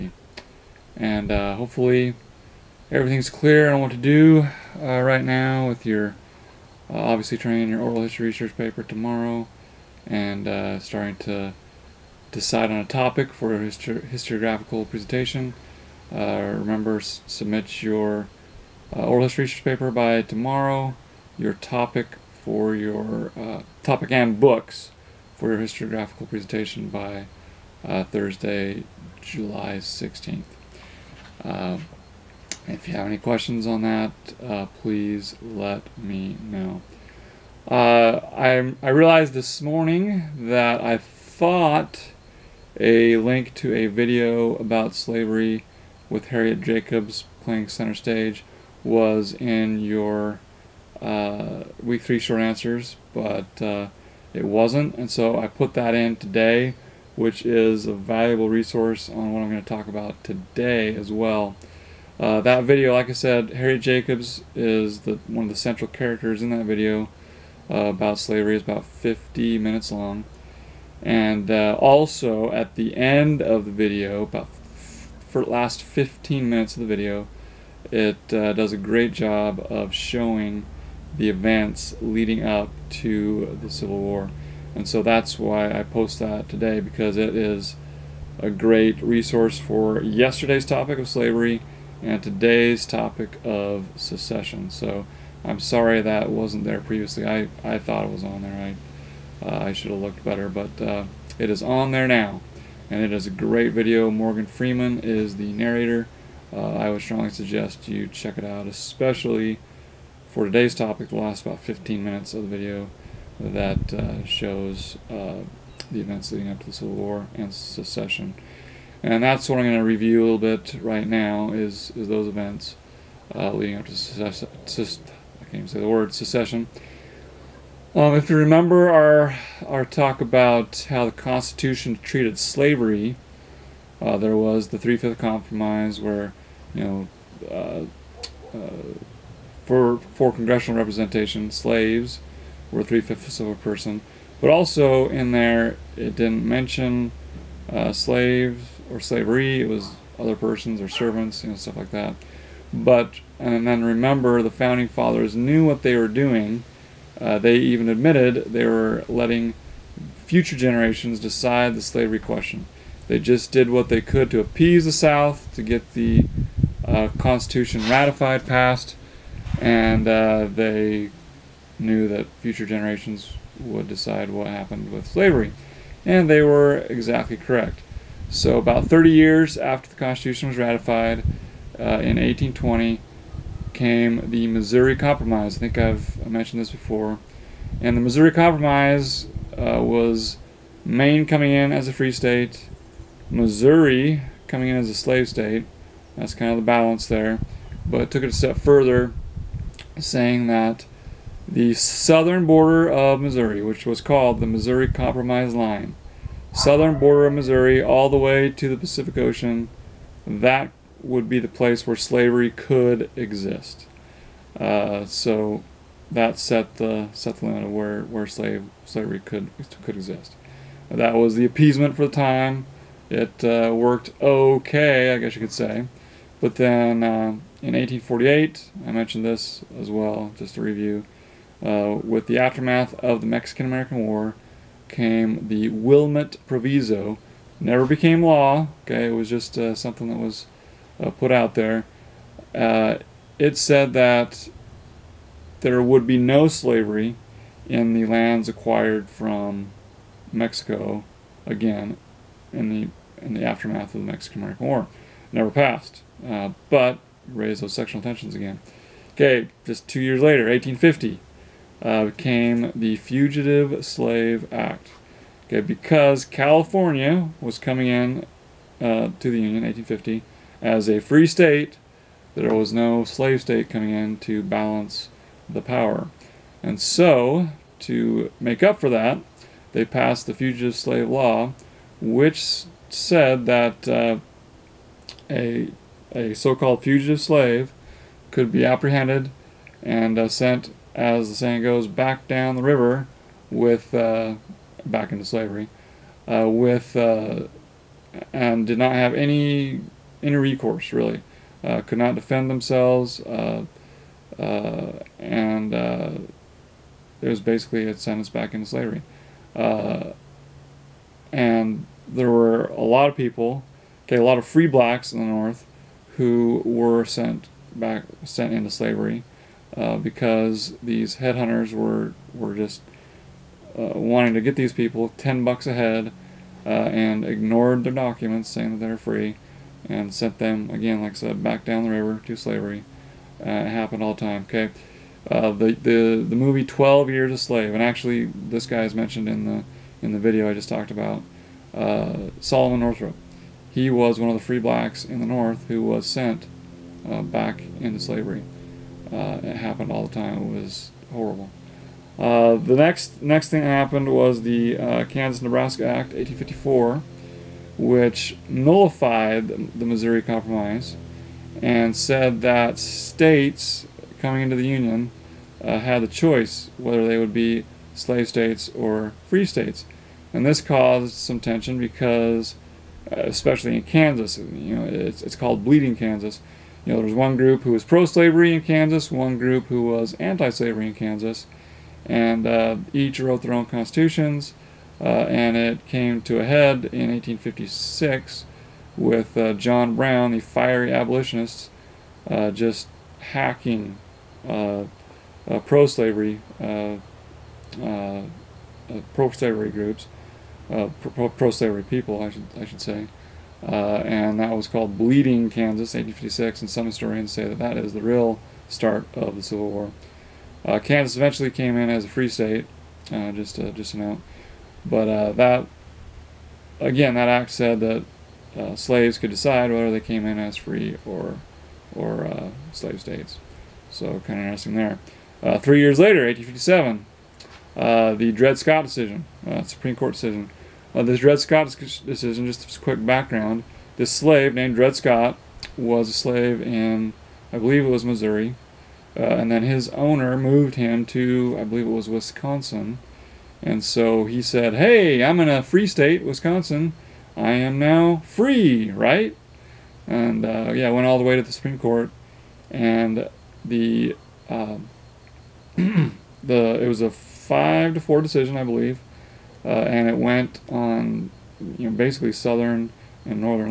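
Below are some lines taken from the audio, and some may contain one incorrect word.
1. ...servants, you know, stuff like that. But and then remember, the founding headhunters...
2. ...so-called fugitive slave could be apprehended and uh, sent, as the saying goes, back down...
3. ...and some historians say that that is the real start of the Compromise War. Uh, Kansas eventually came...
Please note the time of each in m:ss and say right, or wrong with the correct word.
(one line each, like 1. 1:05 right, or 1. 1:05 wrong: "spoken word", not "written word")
1. 2:30 wrong: "fathers", not "headhunters"
2. 4:46 right
3. 6:46 wrong: "Civil", not "Compromise".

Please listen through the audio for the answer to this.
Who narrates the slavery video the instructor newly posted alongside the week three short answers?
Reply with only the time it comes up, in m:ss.
1:44.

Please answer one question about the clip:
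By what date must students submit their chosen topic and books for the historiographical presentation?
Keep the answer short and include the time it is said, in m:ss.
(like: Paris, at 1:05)
Thursday, July 16th, at 0:28.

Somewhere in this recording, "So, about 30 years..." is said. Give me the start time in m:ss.
2:58.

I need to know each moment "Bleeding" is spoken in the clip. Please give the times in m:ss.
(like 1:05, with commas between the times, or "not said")
6:15, 6:44.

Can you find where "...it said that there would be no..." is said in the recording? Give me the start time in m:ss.
4:03.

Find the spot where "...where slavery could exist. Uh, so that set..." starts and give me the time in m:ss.
3:31.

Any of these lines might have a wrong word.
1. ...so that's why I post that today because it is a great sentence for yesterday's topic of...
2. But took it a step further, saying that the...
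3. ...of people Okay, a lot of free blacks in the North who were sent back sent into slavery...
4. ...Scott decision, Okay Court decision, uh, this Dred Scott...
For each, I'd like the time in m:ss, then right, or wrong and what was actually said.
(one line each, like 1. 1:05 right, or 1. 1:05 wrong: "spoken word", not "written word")
1. 1:24 wrong: "resource", not "sentence"
2. 3:17 right
3. 5:13 right
4. 7:08 wrong: "Supreme", not "Okay".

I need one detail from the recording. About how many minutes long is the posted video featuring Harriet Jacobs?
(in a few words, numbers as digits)
50.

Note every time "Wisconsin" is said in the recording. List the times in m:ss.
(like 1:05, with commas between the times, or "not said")
7:22, 7:26.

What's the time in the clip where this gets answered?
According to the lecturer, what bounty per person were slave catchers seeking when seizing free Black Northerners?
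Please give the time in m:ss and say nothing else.
5:25.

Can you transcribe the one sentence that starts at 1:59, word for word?
And that's what I'm going to review a little bit right now is, is those events uh, leading up to secession.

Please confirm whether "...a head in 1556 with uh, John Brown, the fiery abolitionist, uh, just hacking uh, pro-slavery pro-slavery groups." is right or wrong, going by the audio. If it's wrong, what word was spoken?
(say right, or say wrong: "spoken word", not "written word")
wrong: "1856", not "1556".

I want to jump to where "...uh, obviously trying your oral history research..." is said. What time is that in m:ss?
0:06.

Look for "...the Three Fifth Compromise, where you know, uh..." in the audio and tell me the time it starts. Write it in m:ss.
2:14.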